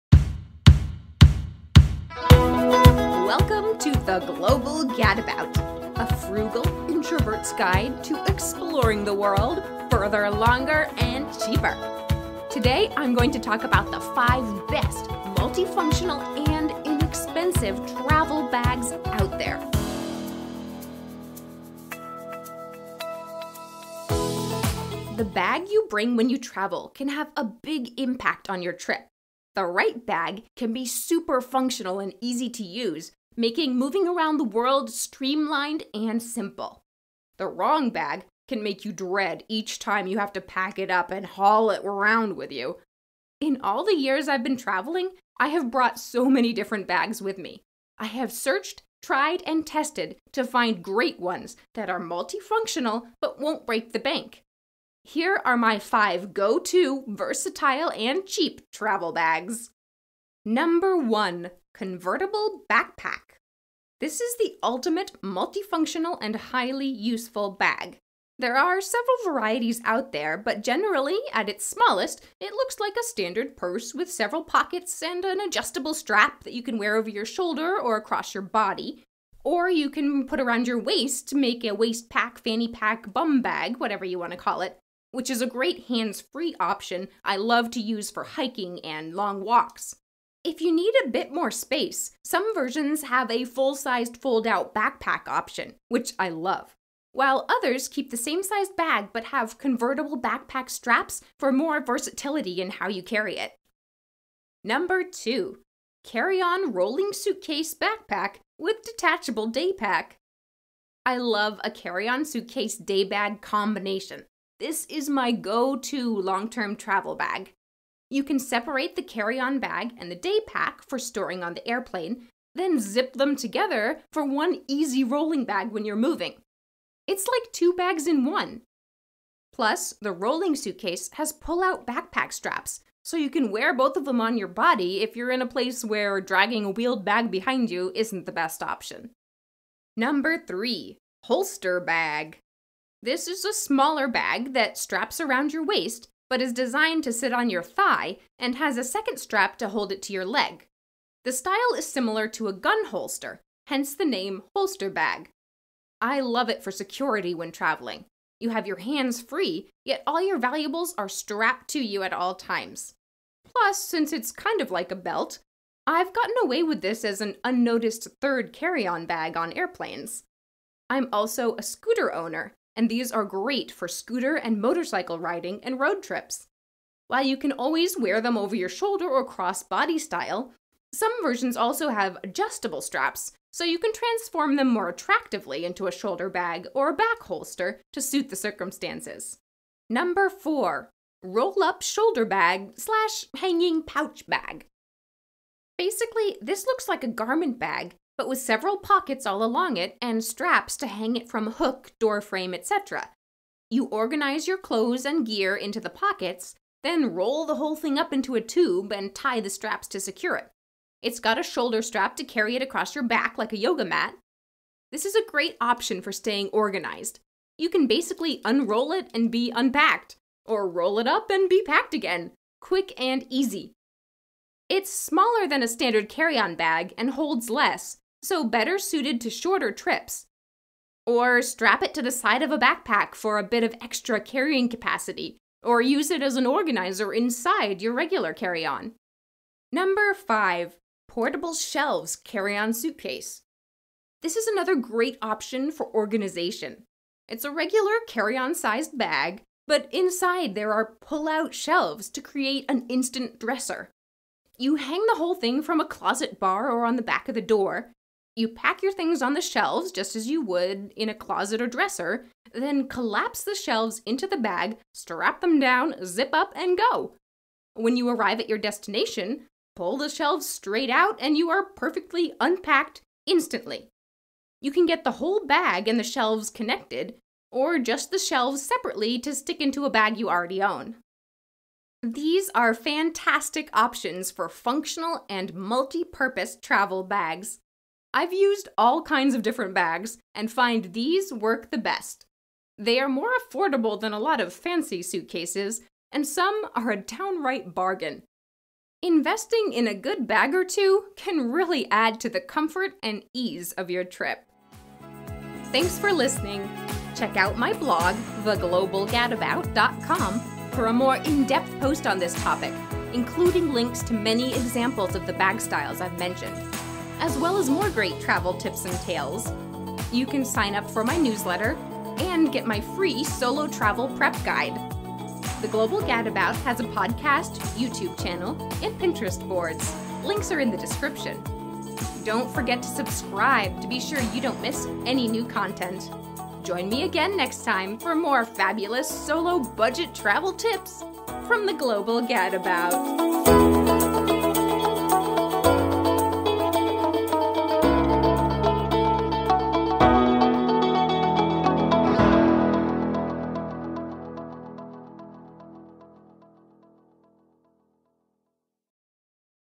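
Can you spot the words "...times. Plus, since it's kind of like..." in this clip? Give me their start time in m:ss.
2:42.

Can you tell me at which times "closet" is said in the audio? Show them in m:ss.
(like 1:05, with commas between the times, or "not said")
4:15, 4:21.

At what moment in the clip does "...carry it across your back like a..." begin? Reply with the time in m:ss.
3:32.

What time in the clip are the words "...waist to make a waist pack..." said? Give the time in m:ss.
1:20.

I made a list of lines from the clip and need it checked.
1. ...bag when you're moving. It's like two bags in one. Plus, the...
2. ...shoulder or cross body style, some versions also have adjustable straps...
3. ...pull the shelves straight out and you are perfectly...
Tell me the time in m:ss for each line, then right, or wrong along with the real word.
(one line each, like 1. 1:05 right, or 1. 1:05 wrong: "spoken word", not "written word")
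1. 2:05 right
2. 2:58 right
3. 4:29 right.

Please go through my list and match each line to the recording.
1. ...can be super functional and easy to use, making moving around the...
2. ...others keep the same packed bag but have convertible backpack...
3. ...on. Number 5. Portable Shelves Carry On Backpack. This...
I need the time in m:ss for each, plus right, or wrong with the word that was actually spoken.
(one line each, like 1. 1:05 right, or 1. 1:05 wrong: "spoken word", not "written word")
1. 0:30 right
2. 1:37 wrong: "sized", not "packed"
3. 3:58 wrong: "Suitcase", not "Backpack".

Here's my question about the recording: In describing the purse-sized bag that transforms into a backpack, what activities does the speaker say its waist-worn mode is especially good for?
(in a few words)
hiking and long walks.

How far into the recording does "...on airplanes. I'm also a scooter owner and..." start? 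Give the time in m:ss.
2:49.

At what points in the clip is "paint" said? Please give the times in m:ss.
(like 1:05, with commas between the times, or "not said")
not said.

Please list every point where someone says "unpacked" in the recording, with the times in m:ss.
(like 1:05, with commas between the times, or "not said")
3:39, 4:32.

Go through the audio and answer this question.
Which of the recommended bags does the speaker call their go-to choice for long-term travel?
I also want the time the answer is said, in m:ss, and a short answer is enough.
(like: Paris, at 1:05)
Carry on rolling suitcase backpack, at 1:46.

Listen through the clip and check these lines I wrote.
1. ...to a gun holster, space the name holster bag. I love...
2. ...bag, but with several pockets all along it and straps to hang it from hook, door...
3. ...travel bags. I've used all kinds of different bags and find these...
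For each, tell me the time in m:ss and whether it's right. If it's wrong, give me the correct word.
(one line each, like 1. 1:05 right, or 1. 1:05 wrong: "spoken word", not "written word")
1. 2:32 wrong: "hence", not "space"
2. 3:17 right
3. 4:46 right.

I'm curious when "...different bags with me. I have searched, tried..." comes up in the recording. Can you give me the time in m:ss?
0:46.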